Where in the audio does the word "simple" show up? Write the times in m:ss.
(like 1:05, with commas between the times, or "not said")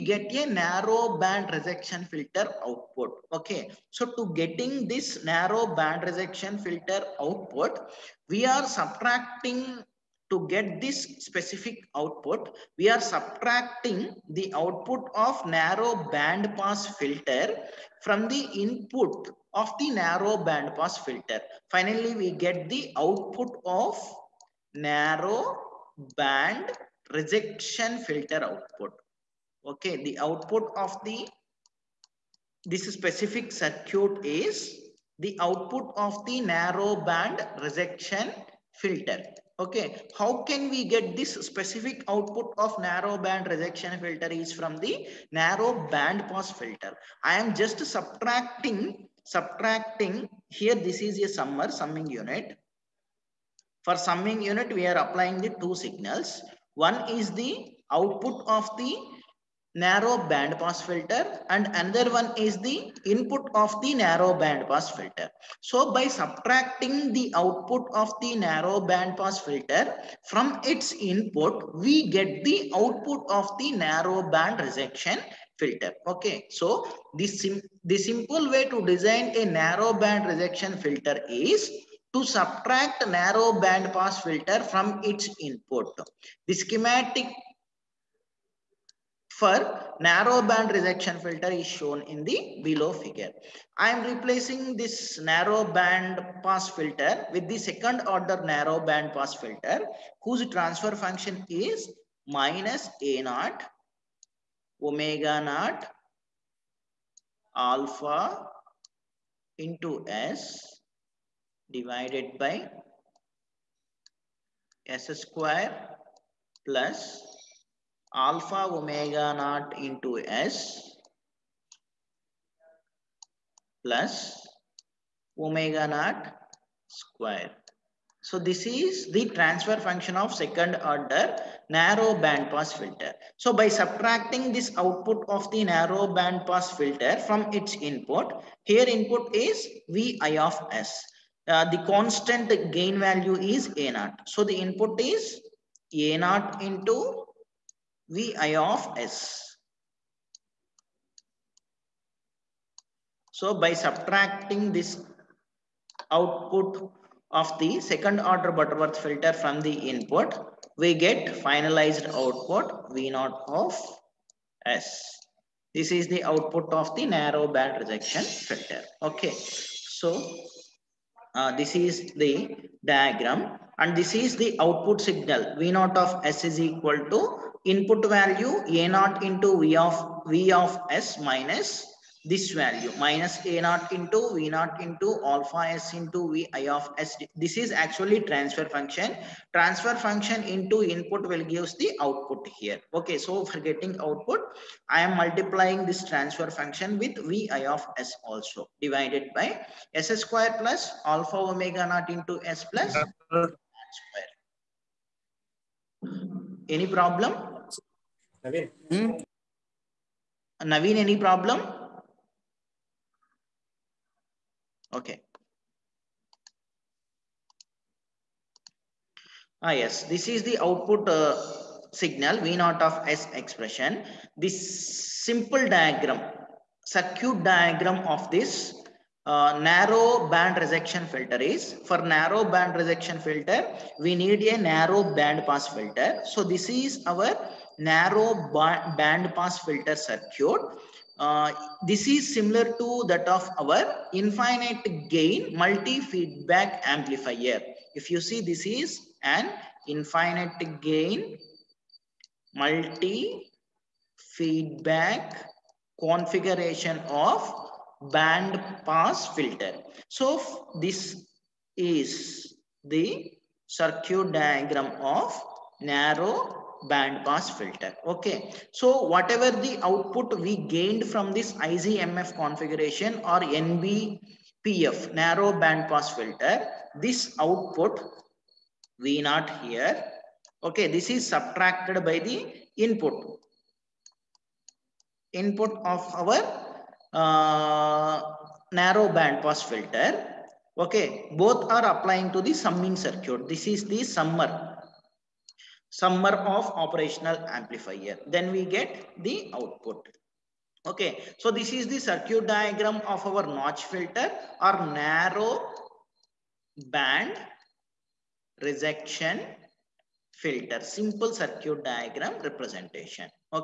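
1:17, 3:45, 5:10.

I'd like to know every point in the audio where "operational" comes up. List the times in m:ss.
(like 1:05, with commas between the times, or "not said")
4:56.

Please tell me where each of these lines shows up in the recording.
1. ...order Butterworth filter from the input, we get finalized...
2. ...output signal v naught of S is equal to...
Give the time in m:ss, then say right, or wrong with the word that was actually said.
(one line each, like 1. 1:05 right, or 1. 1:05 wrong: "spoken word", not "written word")
1. 2:38 right
2. 2:54 right.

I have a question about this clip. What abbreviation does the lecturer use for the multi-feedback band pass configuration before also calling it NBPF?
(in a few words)
IGMF.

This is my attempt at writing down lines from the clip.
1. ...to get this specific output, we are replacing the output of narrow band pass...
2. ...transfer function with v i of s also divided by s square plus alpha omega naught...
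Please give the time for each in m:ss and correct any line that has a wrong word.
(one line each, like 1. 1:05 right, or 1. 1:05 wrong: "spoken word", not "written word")
1. 0:10 wrong: "subtracting", not "replacing"
2. 3:16 right.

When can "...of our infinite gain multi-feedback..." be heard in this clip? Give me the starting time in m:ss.
4:03.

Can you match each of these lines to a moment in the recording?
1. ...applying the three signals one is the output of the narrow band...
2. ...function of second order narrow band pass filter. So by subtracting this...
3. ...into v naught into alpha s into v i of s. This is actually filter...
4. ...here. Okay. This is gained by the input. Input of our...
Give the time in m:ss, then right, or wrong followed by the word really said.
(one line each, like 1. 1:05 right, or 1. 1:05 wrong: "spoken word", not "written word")
1. 0:54 wrong: "two", not "three"
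2. 2:09 right
3. 3:03 wrong: "transfer", not "filter"
4. 4:39 wrong: "subtracted", not "gained".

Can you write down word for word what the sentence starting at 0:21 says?
Finally, we get the output of narrow band rejection filter output.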